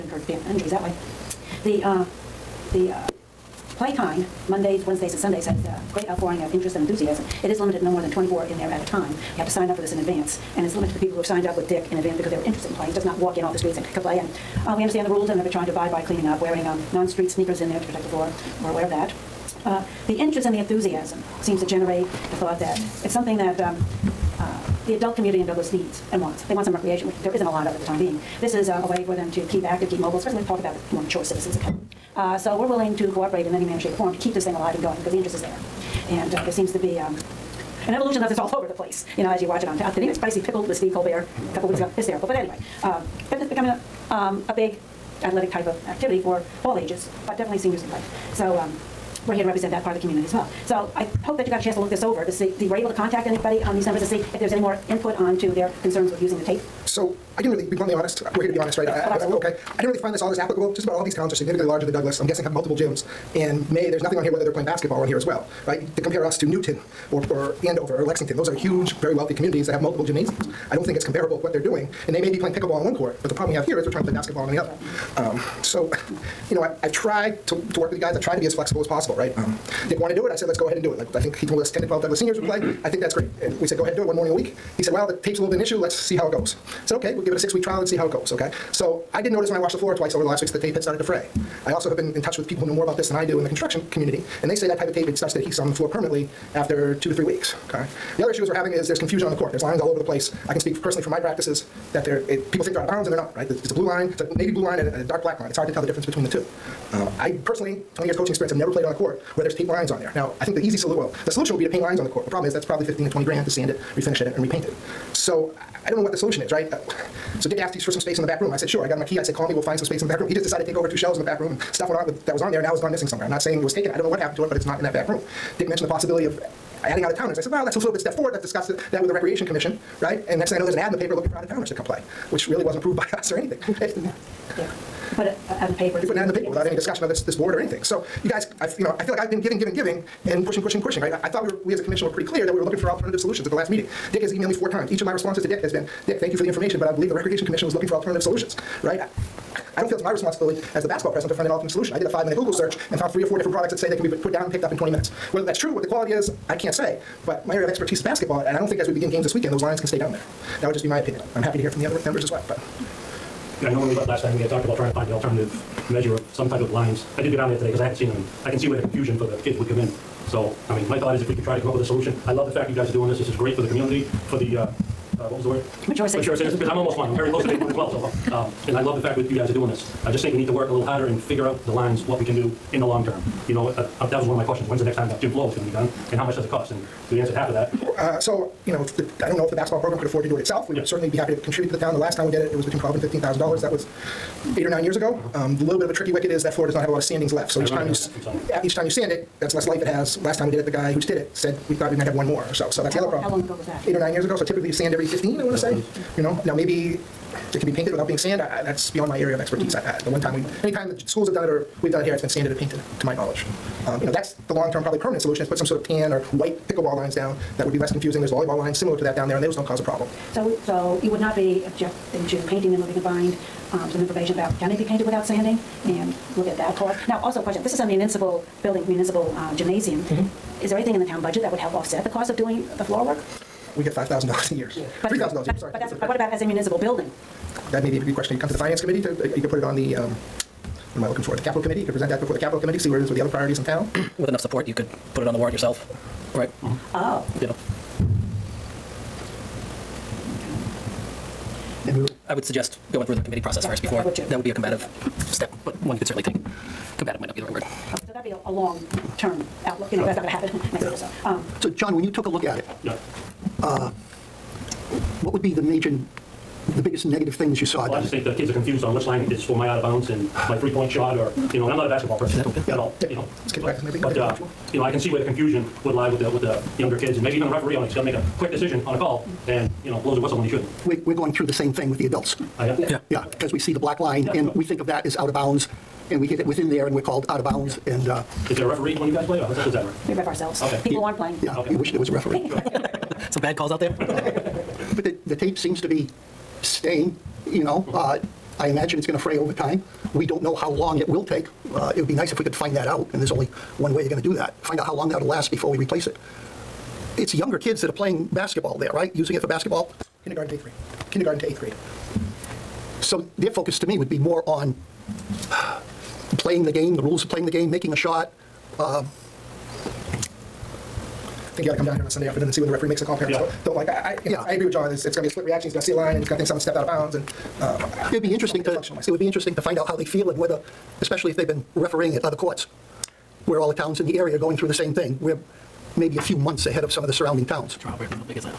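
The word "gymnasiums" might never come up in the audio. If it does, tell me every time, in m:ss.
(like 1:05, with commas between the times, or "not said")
1:10, 3:49.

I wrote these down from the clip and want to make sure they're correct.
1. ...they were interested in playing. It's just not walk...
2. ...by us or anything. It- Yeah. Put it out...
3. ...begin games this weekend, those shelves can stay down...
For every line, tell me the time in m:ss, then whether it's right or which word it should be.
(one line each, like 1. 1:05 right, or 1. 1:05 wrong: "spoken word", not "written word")
1. 0:12 right
2. 2:12 right
3. 2:38 wrong: "lines", not "shelves".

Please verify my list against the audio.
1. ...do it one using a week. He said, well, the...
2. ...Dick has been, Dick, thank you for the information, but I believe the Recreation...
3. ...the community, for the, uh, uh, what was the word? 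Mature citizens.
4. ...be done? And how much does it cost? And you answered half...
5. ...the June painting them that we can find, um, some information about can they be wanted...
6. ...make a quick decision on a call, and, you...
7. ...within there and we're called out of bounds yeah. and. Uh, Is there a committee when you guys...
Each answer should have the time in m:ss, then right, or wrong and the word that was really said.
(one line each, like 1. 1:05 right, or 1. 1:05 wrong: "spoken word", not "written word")
1. 1:23 wrong: "morning", not "using"
2. 2:25 right
3. 2:53 right
4. 3:05 right
5. 3:42 wrong: "painted", not "wanted"
6. 4:38 right
7. 4:46 wrong: "referee", not "committee".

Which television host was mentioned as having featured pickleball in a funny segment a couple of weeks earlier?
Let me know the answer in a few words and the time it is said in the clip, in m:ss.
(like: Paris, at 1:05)
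Steve Colbert, at 0:40.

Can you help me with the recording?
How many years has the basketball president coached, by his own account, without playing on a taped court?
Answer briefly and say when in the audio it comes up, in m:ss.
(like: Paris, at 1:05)
20 years, at 1:47.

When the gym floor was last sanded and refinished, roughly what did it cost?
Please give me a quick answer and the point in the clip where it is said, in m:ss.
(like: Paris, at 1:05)
$12,000 to $15,000, at 3:12.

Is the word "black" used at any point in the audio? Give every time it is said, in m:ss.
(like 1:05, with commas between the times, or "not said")
1:45, 4:43.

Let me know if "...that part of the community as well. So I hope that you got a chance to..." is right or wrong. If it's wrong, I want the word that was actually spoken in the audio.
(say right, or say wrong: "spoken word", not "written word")
right.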